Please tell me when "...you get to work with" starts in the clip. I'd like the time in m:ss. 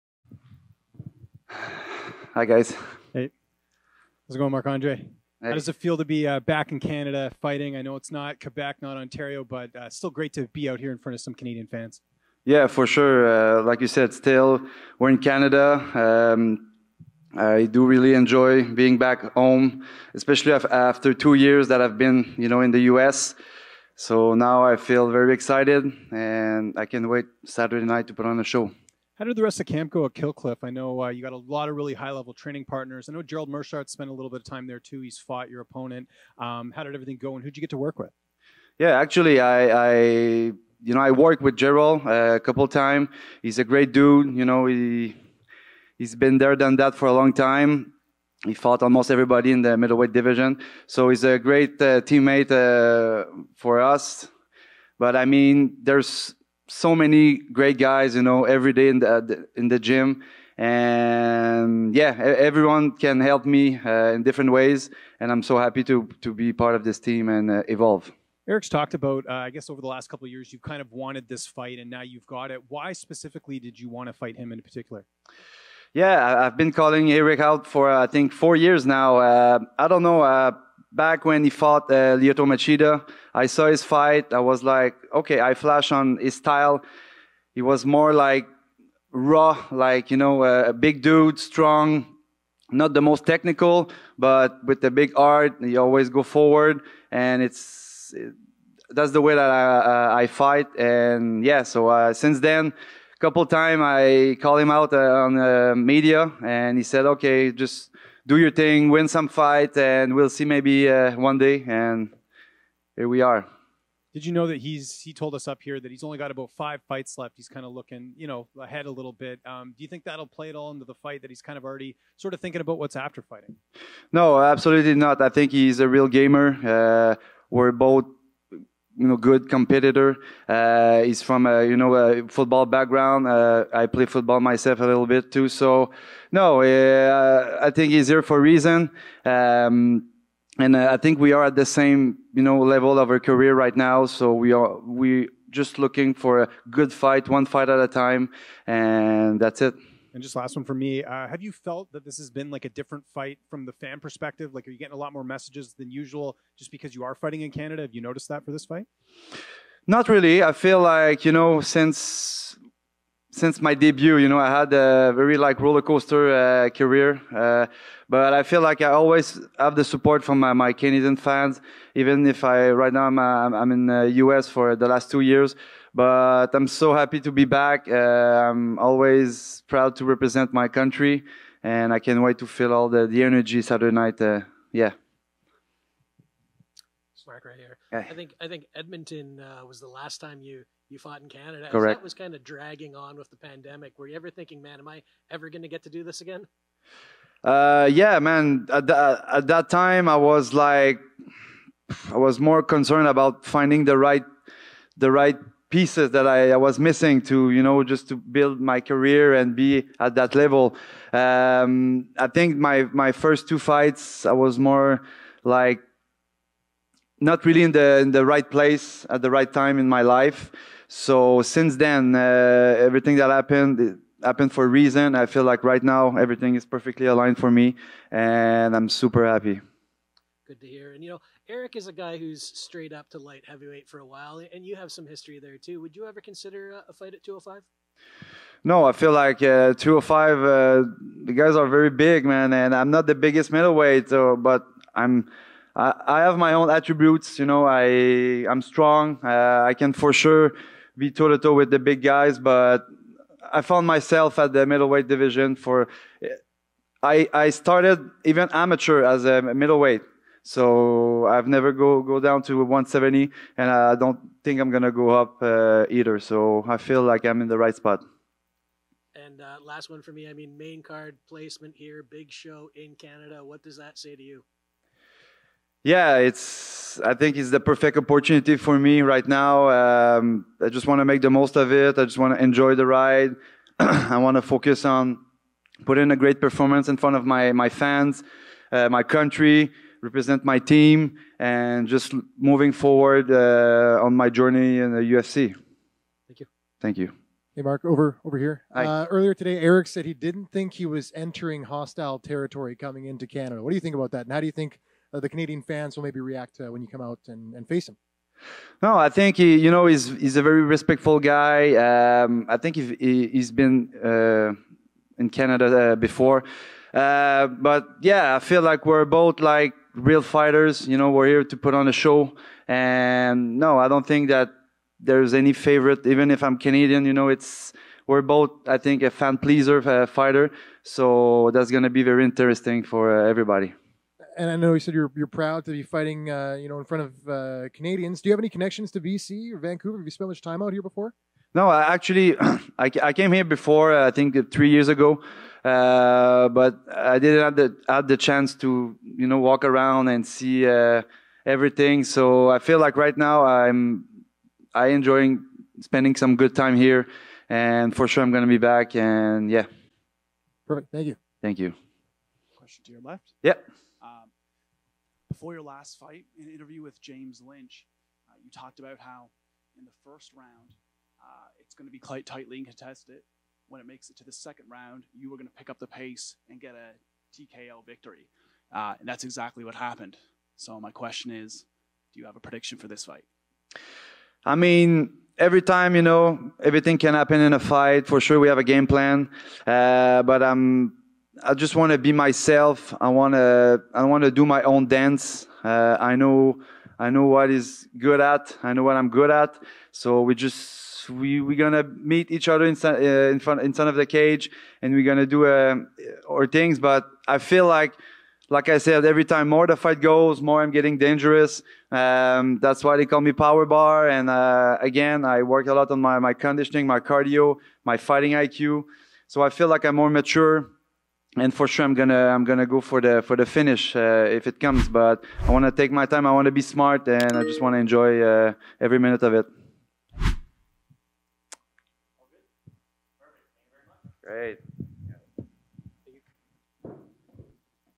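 0:37.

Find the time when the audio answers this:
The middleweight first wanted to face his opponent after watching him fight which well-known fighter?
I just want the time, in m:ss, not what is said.
1:22.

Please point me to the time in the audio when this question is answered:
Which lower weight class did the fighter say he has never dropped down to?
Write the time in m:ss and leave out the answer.
4:22.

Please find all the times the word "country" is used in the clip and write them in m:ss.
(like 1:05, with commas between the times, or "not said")
3:00, 4:49.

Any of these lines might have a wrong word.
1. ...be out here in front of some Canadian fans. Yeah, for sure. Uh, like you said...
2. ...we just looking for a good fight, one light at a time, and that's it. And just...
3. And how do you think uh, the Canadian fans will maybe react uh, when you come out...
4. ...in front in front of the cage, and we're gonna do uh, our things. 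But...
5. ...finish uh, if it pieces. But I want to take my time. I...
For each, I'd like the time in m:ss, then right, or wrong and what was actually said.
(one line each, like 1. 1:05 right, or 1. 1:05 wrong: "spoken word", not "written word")
1. 0:10 right
2. 2:24 wrong: "fight", not "light"
3. 5:04 right
4. 6:43 right
5. 7:03 wrong: "comes", not "pieces".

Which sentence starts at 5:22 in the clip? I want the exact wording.
And no, I don't think that there's any favorite.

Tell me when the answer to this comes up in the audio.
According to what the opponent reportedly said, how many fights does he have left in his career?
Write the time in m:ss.
1:56.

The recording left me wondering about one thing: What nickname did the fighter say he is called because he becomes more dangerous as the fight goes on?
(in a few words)
Power Bar.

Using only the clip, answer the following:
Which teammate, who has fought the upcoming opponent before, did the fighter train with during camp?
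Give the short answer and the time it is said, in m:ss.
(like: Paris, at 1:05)
Gerald Meerschaert, at 0:33.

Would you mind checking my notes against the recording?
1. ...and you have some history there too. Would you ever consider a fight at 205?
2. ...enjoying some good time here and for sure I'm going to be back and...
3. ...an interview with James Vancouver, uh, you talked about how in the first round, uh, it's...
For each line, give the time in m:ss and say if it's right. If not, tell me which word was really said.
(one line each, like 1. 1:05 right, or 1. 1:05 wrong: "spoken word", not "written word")
1. 3:54 right
2. 5:55 wrong: "spending", not "enjoying"
3. 6:06 wrong: "Lynch", not "Vancouver".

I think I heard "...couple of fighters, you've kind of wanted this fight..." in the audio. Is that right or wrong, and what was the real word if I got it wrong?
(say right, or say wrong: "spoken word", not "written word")
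wrong: "years", not "fighters".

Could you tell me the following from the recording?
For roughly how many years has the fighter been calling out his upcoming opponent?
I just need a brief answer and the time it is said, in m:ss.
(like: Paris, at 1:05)
4 years, at 1:18.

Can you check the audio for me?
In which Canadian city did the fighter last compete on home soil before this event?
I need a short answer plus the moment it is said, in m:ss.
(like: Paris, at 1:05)
Edmonton, at 3:08.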